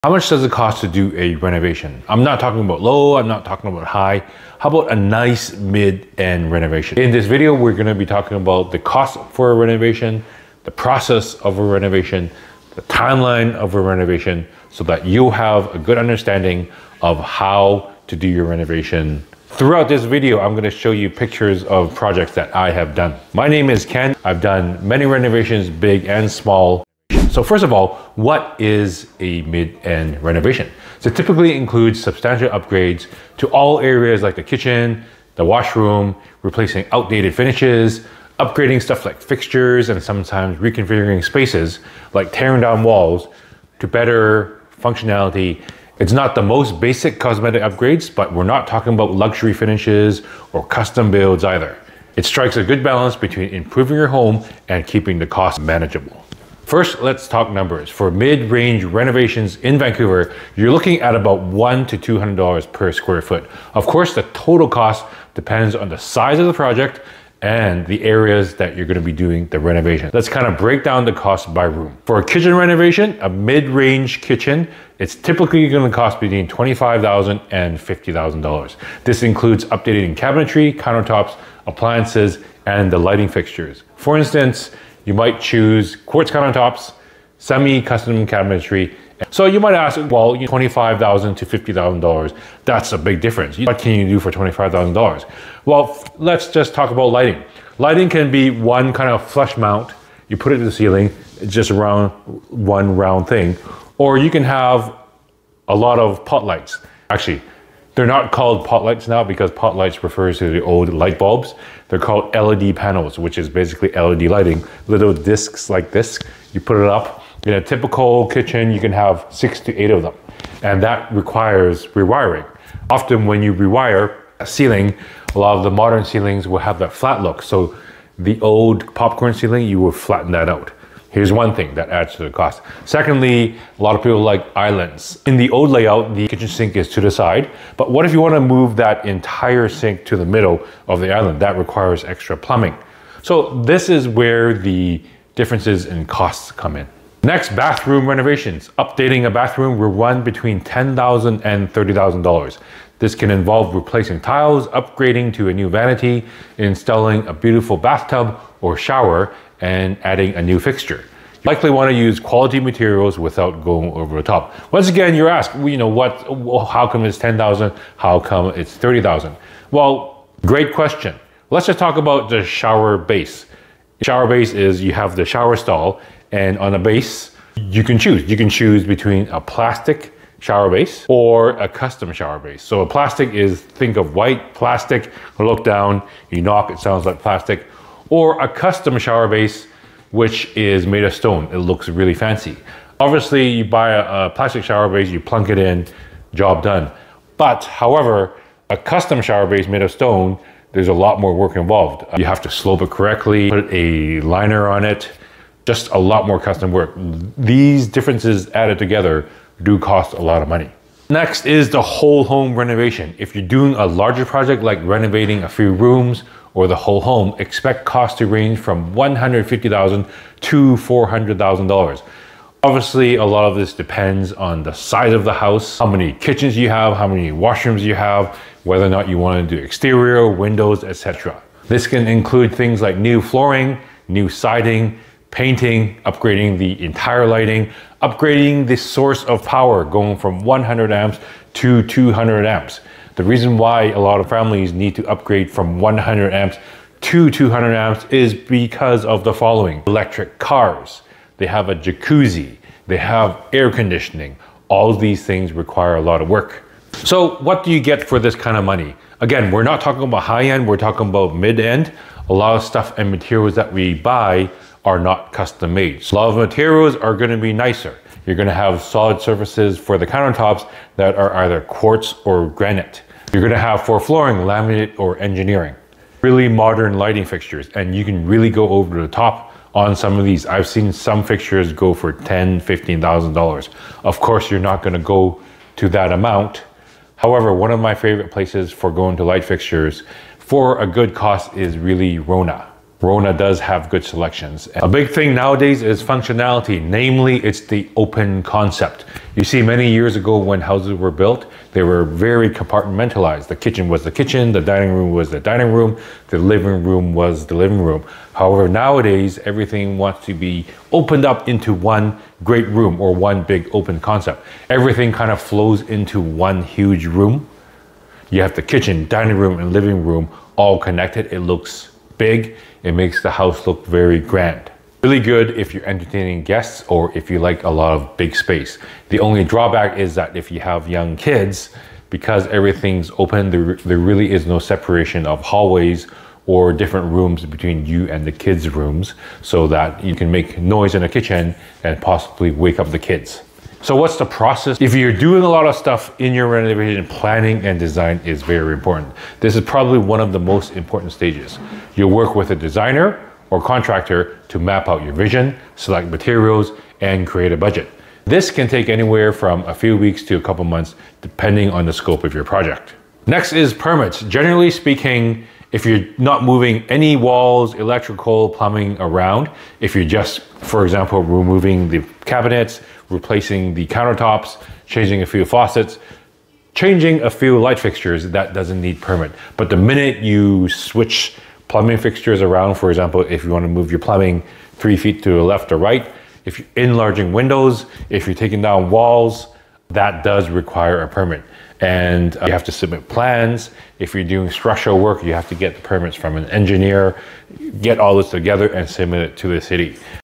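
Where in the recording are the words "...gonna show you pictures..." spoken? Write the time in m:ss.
0:20.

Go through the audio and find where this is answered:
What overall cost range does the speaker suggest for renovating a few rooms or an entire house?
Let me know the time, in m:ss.
3:38.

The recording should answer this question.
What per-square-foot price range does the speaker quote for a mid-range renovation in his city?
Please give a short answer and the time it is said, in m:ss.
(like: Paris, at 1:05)
$100 to $200, at 1:01.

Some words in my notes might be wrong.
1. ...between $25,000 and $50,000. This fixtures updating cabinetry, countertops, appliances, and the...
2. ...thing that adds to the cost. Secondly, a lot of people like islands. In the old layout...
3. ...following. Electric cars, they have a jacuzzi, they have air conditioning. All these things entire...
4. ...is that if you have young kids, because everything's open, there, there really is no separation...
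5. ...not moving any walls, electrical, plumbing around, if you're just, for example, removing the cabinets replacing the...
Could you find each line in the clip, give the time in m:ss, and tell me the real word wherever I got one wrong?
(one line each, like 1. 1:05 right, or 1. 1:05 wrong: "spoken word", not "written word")
1. 1:16 wrong: "includes", not "fixtures"
2. 2:11 right
3. 4:09 wrong: "require", not "entire"
4. 5:29 right
5. 6:06 right.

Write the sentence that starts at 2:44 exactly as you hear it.
Once again, you're asked, you know, what, how come it's 10,000?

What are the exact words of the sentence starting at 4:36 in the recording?
Really modern lighting fixtures and you can really go over the top on some of these.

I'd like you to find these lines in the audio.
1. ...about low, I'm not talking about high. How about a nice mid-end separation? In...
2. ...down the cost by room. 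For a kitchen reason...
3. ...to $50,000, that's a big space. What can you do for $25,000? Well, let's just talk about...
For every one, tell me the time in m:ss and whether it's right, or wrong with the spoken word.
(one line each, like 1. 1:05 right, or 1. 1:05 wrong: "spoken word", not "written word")
1. 0:02 wrong: "renovation", not "separation"
2. 1:10 wrong: "renovation", not "reason"
3. 1:31 wrong: "difference", not "space".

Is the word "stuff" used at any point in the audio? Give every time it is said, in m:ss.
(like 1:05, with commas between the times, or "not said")
0:38, 4:22, 5:45.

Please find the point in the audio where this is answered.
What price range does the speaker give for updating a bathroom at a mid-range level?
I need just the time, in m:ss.
2:30.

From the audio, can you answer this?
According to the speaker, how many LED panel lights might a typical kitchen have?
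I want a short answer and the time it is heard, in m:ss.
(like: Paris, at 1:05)
6 to 8, at 1:59.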